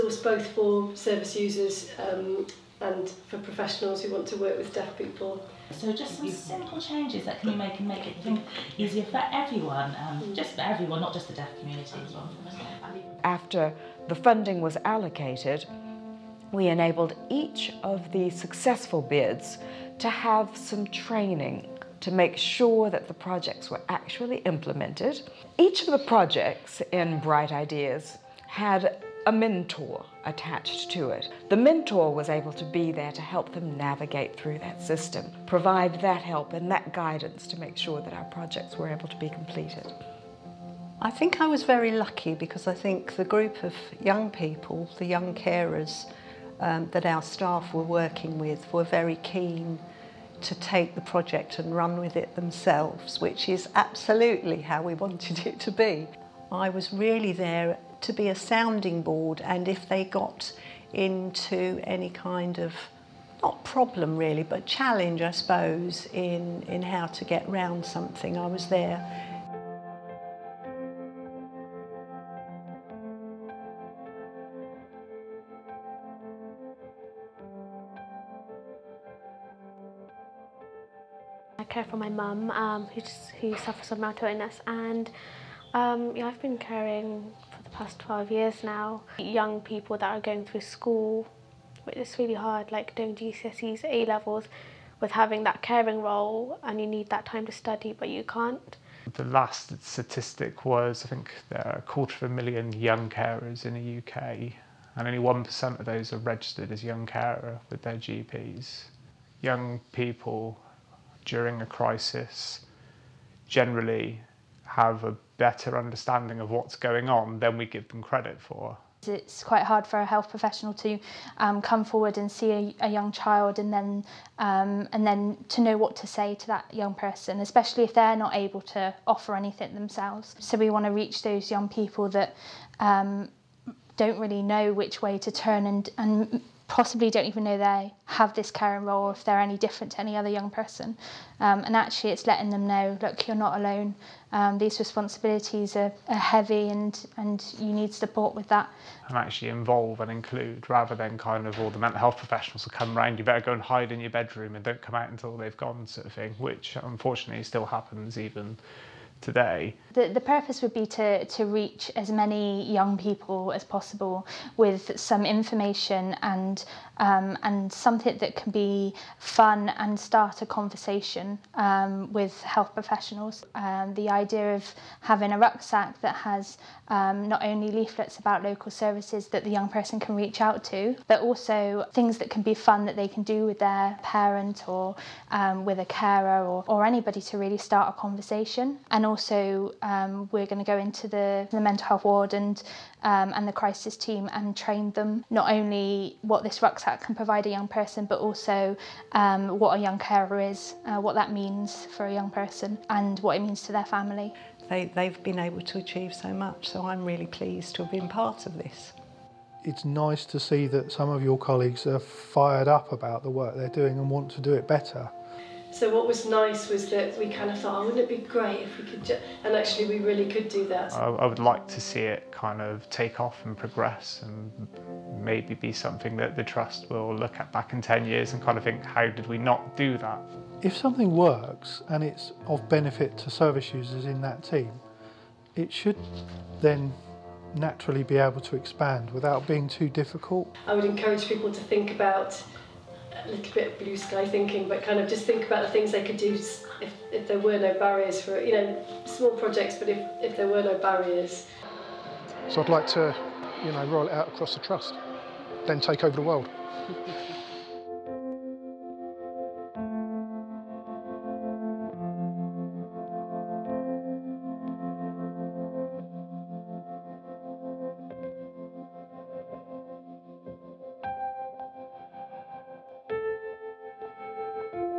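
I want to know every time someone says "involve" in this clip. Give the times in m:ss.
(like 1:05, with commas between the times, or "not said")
2:29.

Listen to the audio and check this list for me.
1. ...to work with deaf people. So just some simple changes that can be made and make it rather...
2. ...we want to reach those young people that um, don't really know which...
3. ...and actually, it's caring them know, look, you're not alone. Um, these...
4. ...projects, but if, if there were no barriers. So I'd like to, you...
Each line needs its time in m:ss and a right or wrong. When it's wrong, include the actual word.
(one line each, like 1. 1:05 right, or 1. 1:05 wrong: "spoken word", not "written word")
1. 0:04 wrong: "easier", not "rather"
2. 2:10 right
3. 2:21 wrong: "letting", not "caring"
4. 4:09 right.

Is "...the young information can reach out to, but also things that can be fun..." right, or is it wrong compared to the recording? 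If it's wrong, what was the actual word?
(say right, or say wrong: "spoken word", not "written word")
wrong: "person", not "information".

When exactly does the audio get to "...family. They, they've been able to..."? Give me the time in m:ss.
3:23.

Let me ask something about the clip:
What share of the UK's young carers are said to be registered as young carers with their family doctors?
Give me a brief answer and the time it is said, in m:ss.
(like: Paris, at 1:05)
1%, at 1:45.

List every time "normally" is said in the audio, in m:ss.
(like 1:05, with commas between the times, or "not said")
not said.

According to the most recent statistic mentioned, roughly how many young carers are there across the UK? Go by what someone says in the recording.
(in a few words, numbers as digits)
a quarter of a million.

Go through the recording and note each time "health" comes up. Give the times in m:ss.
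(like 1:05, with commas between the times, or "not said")
2:00, 2:31, 2:52, 3:11.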